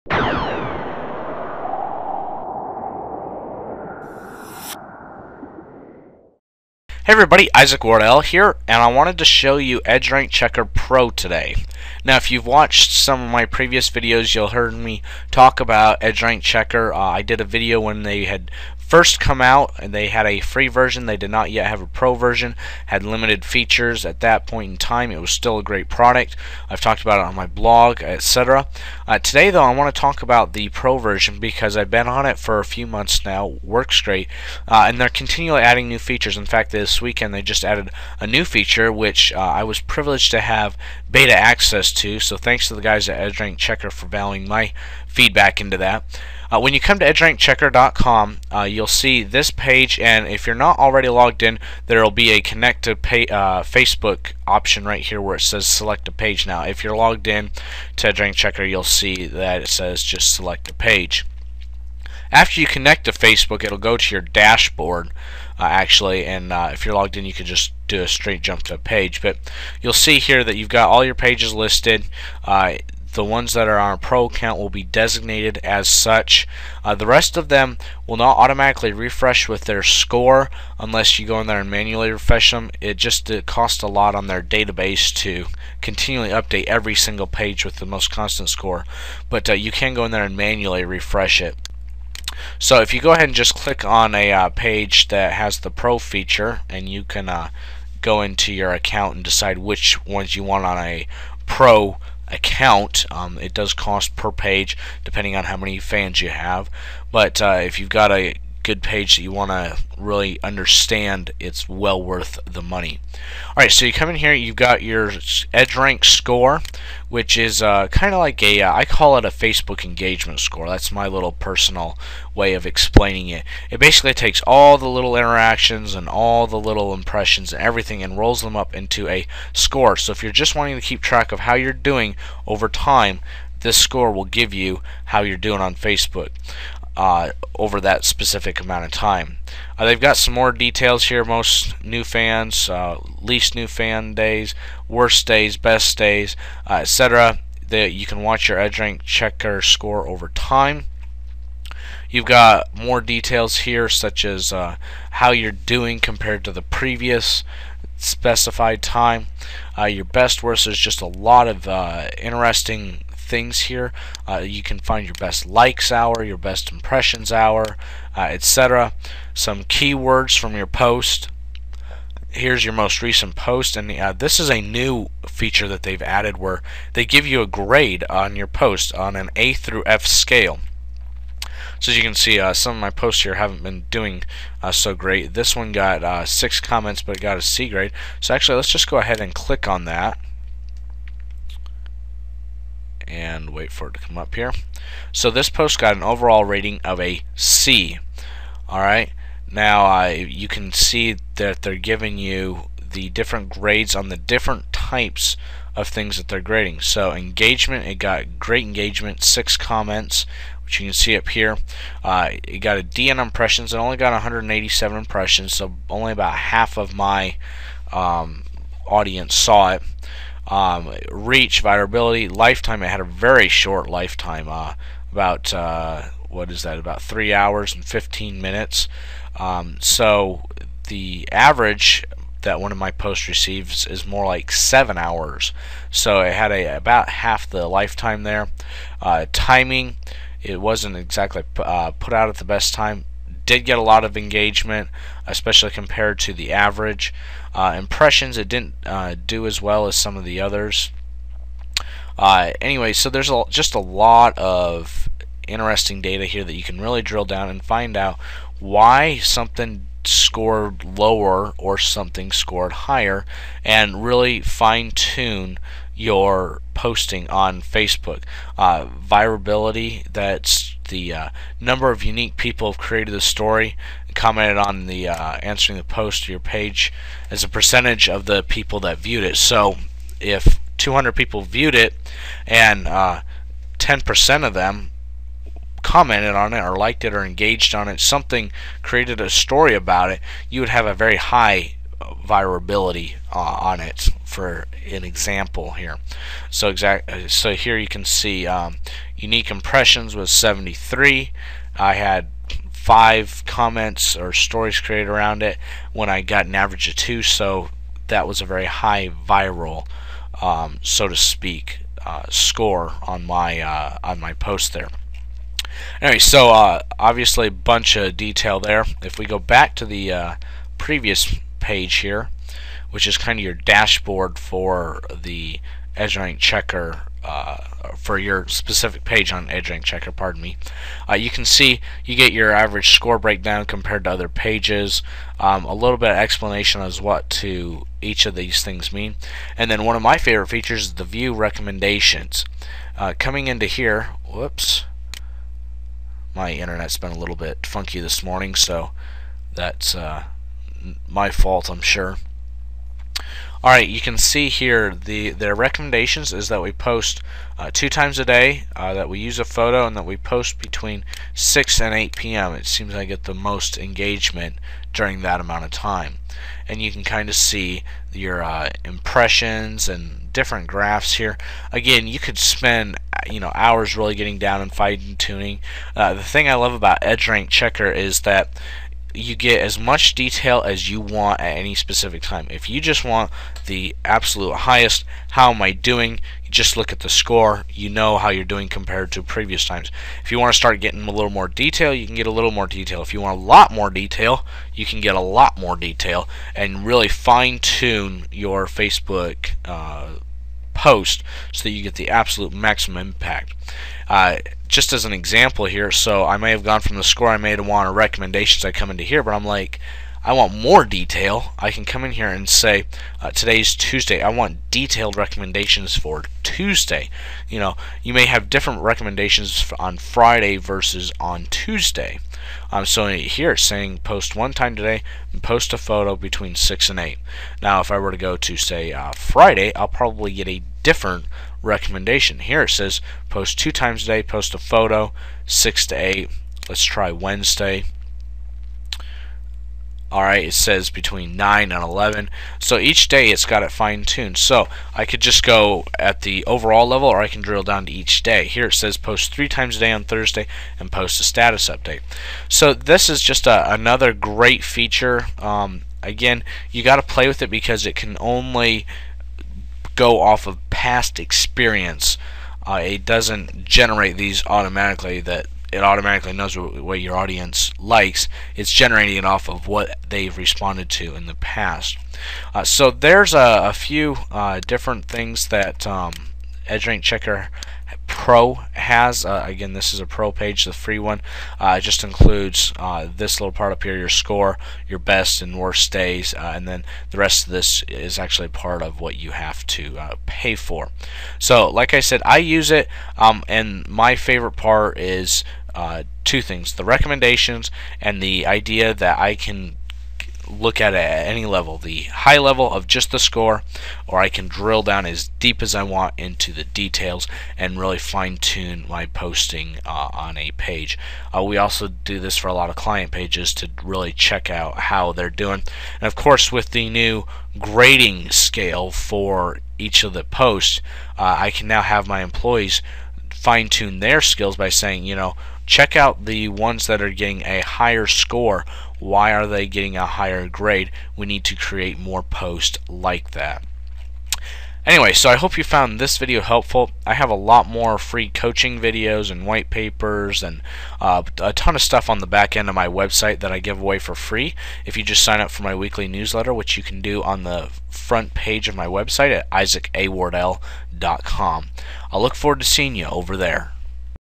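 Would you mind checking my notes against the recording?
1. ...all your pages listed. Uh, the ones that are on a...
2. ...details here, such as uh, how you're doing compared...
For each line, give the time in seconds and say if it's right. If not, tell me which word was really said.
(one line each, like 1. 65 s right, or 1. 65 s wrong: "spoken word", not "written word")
1. 70 s right
2. 152 s right.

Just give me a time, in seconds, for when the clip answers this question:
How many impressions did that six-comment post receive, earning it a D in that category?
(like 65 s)
214 s.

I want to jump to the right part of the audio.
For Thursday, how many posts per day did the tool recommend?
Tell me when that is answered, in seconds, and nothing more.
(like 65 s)
449 s.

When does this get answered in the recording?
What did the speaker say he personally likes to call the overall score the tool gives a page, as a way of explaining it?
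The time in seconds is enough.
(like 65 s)
119 s.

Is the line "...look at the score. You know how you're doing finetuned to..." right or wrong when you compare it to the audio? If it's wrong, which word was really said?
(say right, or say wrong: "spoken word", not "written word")
wrong: "compared", not "finetuned".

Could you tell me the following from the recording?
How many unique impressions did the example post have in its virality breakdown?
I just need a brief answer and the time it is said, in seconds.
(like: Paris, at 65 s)
73, at 300 s.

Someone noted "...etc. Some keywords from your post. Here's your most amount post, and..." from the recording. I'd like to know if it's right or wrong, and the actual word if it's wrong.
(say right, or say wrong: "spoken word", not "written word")
wrong: "recent", not "amount".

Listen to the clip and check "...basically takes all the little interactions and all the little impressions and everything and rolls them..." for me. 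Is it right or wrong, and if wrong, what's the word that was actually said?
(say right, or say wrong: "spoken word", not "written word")
right.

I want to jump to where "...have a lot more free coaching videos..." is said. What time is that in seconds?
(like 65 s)
537 s.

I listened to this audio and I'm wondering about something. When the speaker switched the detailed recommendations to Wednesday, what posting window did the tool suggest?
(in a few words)
9 to 11.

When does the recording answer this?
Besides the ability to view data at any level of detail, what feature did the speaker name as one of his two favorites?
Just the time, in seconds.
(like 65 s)
496 s.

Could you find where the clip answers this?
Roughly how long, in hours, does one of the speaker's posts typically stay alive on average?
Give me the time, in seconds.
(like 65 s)
234 s.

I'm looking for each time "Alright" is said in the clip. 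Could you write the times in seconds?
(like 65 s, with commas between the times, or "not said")
113 s, 198 s, 353 s, 440 s.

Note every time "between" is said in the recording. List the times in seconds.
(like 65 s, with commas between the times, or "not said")
360 s, 426 s, 440 s.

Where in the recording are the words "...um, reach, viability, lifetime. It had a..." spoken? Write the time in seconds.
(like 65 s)
220 s.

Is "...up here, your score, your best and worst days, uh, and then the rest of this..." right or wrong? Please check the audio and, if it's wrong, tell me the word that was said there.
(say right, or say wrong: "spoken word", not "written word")
right.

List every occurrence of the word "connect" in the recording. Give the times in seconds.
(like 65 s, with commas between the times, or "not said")
52 s, 62 s.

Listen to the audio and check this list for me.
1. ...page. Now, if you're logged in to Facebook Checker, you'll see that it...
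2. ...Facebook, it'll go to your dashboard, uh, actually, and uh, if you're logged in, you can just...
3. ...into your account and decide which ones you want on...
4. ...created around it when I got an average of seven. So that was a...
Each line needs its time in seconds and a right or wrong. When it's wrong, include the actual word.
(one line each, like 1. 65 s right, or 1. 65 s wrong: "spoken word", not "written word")
1. 56 s wrong: "EdgeRank", not "Facebook"
2. 63 s right
3. 98 s right
4. 304 s wrong: "two", not "seven".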